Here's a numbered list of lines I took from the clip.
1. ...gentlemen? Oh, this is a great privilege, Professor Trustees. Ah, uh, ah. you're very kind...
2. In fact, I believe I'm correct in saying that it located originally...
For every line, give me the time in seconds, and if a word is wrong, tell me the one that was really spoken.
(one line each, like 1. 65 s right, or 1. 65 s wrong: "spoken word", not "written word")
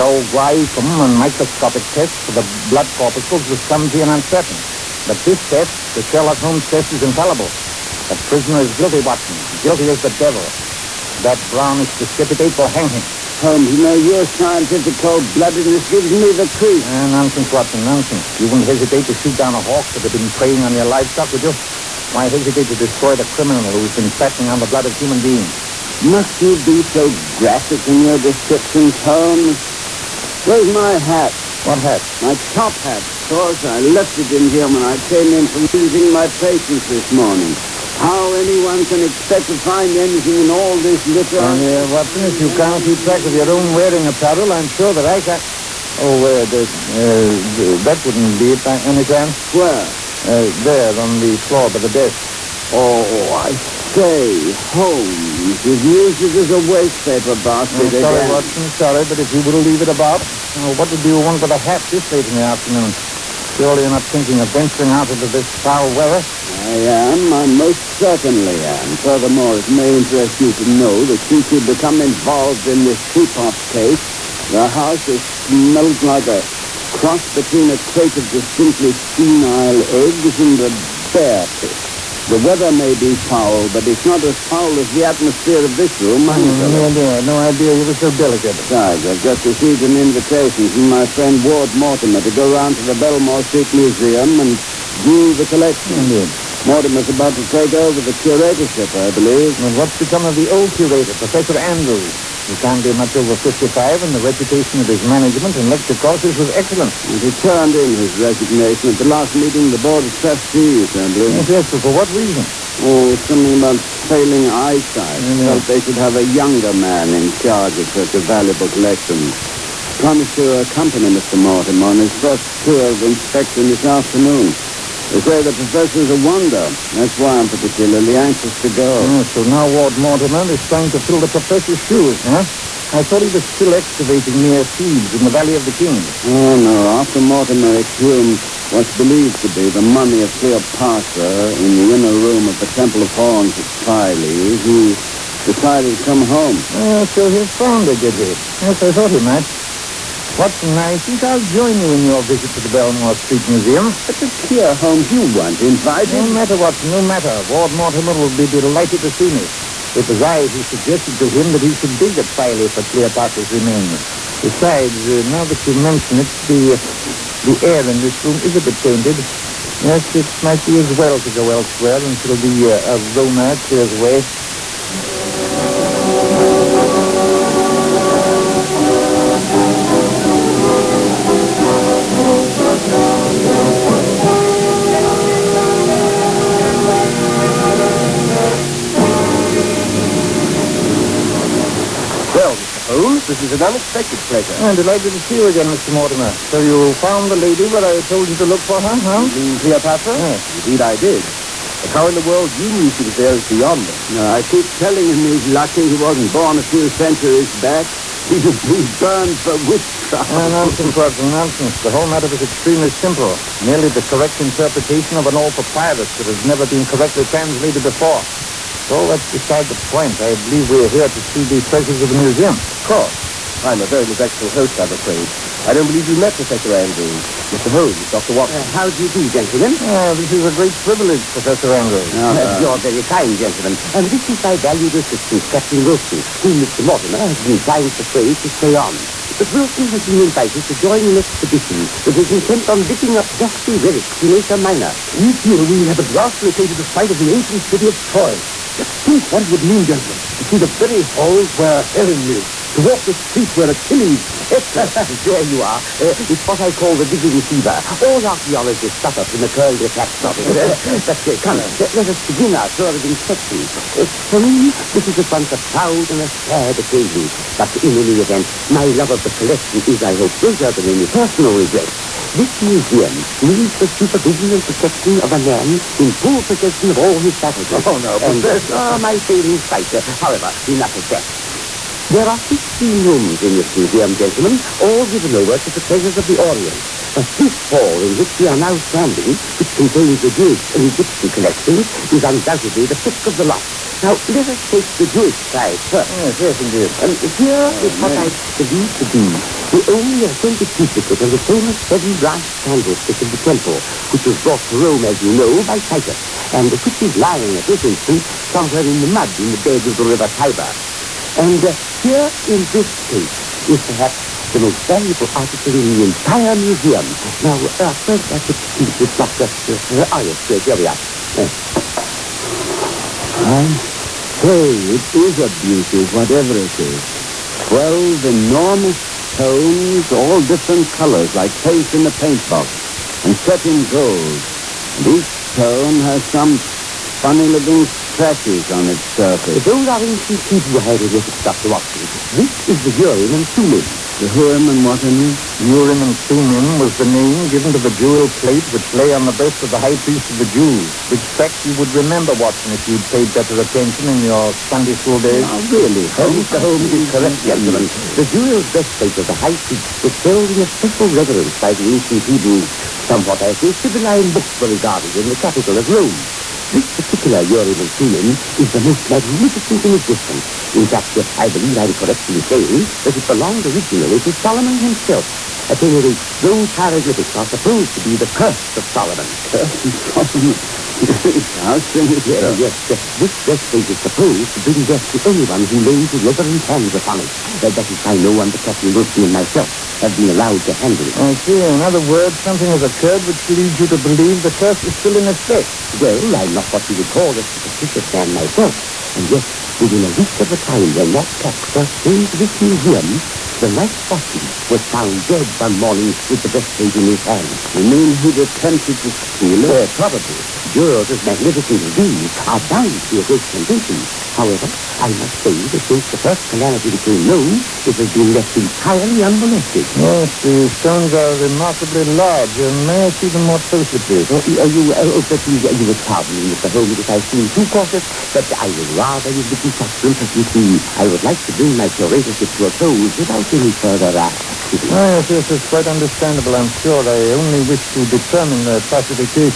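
1. 229 s wrong: "Andrews", not "Trustees"
2. 370 s wrong: "belonged", not "located".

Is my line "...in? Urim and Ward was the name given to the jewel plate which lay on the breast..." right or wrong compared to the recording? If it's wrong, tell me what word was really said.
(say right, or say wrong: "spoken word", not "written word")
wrong: "Thummim", not "Ward".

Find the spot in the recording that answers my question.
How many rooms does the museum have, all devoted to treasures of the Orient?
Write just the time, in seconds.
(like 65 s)
282 s.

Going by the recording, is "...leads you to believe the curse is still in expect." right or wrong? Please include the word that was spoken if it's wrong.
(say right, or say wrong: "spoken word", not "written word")
wrong: "effect", not "expect".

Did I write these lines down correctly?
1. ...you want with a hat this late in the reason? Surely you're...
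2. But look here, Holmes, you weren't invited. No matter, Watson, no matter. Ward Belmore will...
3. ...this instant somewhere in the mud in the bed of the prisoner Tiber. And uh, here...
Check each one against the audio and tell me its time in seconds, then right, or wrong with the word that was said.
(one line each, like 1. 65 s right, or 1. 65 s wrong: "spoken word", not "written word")
1. 61 s wrong: "afternoon", not "reason"
2. 154 s wrong: "Mortimer", not "Belmore"
3. 307 s wrong: "river", not "prisoner".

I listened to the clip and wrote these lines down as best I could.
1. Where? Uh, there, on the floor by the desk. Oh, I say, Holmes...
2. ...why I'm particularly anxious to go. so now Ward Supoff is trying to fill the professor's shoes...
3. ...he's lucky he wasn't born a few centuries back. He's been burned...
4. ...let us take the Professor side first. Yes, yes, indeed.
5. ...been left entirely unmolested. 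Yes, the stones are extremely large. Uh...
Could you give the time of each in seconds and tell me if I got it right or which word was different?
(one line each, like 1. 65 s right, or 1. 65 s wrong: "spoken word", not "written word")
1. 49 s right
2. 127 s wrong: "Mortimer", not "Supoff"
3. 205 s right
4. 294 s wrong: "Jewish", not "Professor"
5. 418 s wrong: "remarkably", not "extremely".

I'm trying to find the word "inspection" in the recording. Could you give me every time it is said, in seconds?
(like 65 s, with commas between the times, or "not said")
122 s, 263 s.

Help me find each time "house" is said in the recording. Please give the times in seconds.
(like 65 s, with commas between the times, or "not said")
74 s, 381 s.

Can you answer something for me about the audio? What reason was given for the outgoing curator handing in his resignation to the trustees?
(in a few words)
Failing eyesight.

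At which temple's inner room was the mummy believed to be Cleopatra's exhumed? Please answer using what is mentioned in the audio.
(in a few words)
Temple of Horus.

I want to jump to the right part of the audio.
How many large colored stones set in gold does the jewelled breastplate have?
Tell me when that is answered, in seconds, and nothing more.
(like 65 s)
327 s.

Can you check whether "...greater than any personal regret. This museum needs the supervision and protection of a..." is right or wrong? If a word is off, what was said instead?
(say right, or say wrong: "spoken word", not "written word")
right.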